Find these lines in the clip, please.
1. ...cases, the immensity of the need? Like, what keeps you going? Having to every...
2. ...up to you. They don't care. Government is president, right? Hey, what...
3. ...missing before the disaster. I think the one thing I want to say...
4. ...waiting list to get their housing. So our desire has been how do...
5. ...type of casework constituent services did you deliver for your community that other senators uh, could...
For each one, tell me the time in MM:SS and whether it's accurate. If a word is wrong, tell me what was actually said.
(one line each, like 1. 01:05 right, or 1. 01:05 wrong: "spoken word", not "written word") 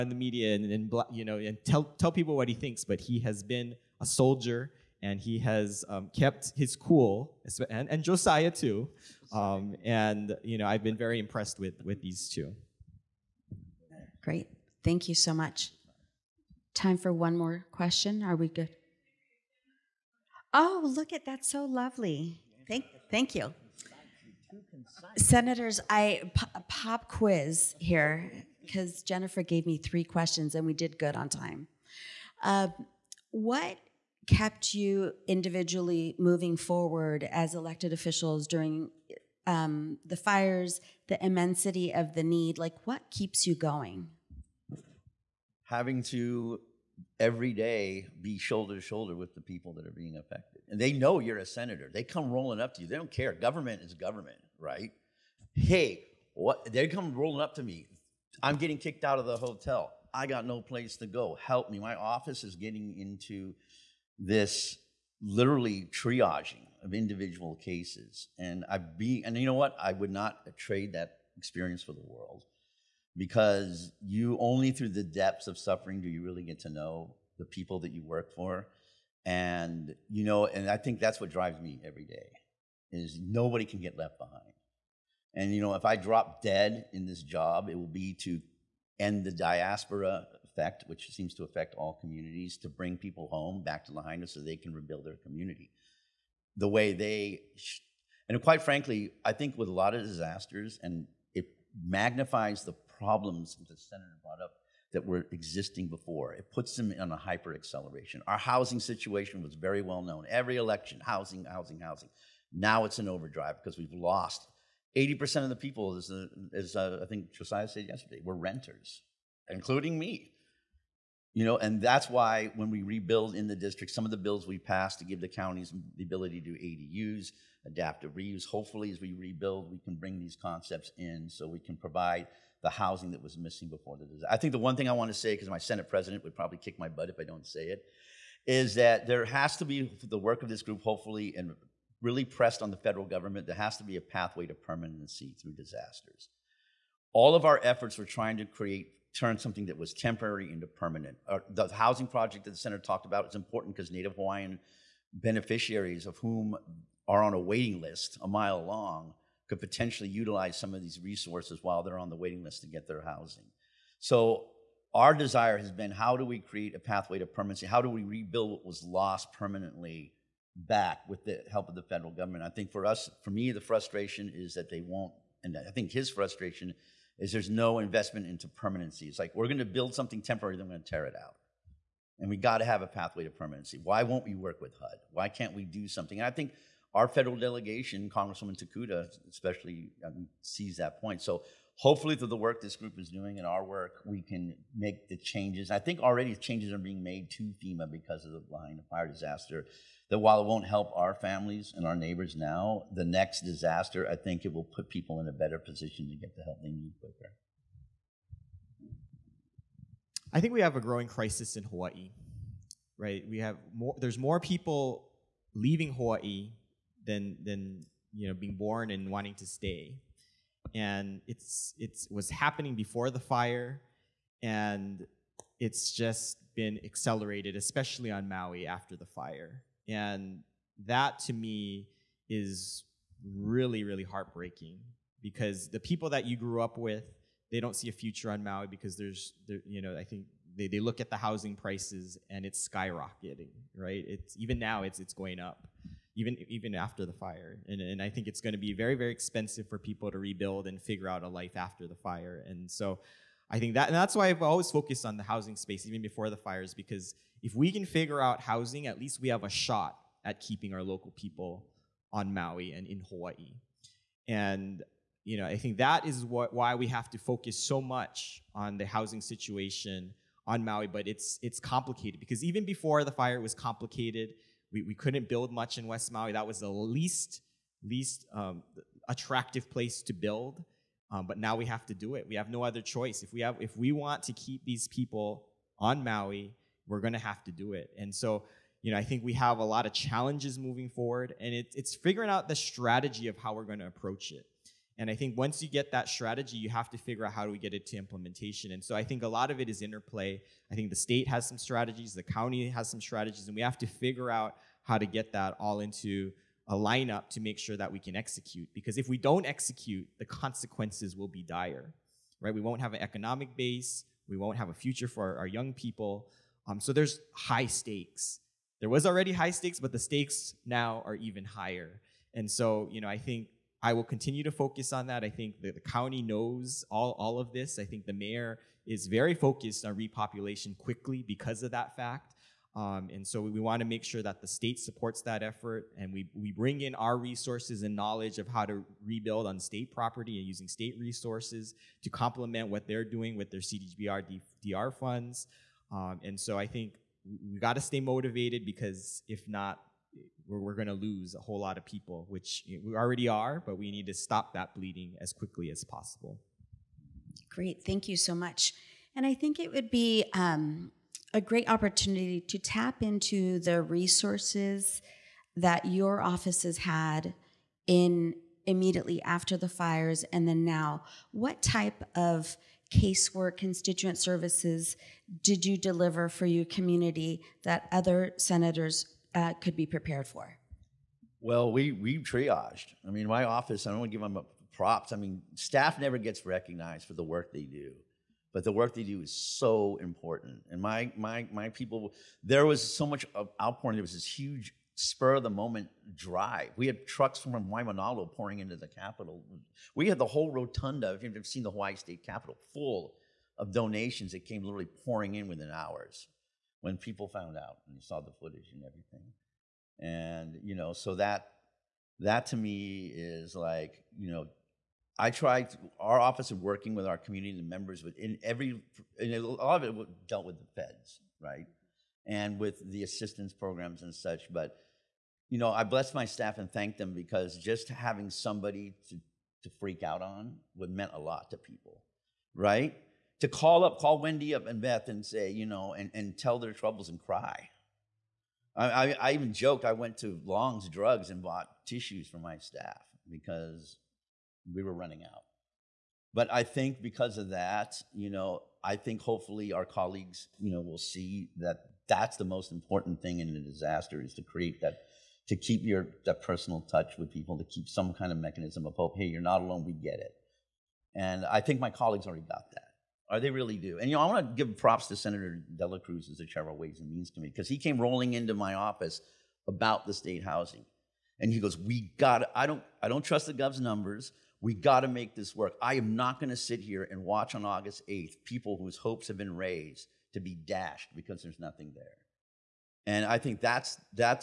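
1. 00:40 wrong: "fires", not "cases"
2. 00:52 wrong: "government", not "president"
3. 02:13 right
4. 02:42 right
5. 06:11 right.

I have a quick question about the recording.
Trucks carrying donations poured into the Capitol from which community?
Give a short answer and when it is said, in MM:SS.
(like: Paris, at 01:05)
Waimanalo, at 06:37.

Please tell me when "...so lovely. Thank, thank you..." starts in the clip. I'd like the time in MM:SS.
00:21.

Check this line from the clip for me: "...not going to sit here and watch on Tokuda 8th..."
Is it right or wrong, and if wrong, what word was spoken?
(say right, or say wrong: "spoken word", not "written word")
wrong: "August", not "Tokuda".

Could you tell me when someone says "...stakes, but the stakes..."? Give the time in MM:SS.
05:19.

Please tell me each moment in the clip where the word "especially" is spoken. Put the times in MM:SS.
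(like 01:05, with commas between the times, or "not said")
03:09, 03:47.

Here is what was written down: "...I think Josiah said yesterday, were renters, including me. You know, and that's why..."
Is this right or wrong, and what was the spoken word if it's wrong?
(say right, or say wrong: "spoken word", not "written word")
right.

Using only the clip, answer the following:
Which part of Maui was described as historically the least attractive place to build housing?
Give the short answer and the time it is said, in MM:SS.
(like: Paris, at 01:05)
West Maui, at 04:35.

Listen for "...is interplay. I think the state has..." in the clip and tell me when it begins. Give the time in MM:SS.
04:59.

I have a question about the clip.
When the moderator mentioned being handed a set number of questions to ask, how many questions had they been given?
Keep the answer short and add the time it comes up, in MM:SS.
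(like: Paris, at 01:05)
3, at 00:29.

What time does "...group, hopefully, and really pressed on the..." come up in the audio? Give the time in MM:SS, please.
02:20.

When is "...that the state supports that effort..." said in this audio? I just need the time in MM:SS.
05:34.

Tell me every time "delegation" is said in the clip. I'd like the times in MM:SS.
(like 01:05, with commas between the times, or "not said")
03:07.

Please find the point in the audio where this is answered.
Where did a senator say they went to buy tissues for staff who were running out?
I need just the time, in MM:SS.
07:20.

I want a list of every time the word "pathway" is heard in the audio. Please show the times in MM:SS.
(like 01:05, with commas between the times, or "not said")
02:24, 02:46, 03:02.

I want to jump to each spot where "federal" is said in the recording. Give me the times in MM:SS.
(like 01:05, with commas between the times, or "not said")
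02:22, 02:51, 03:07.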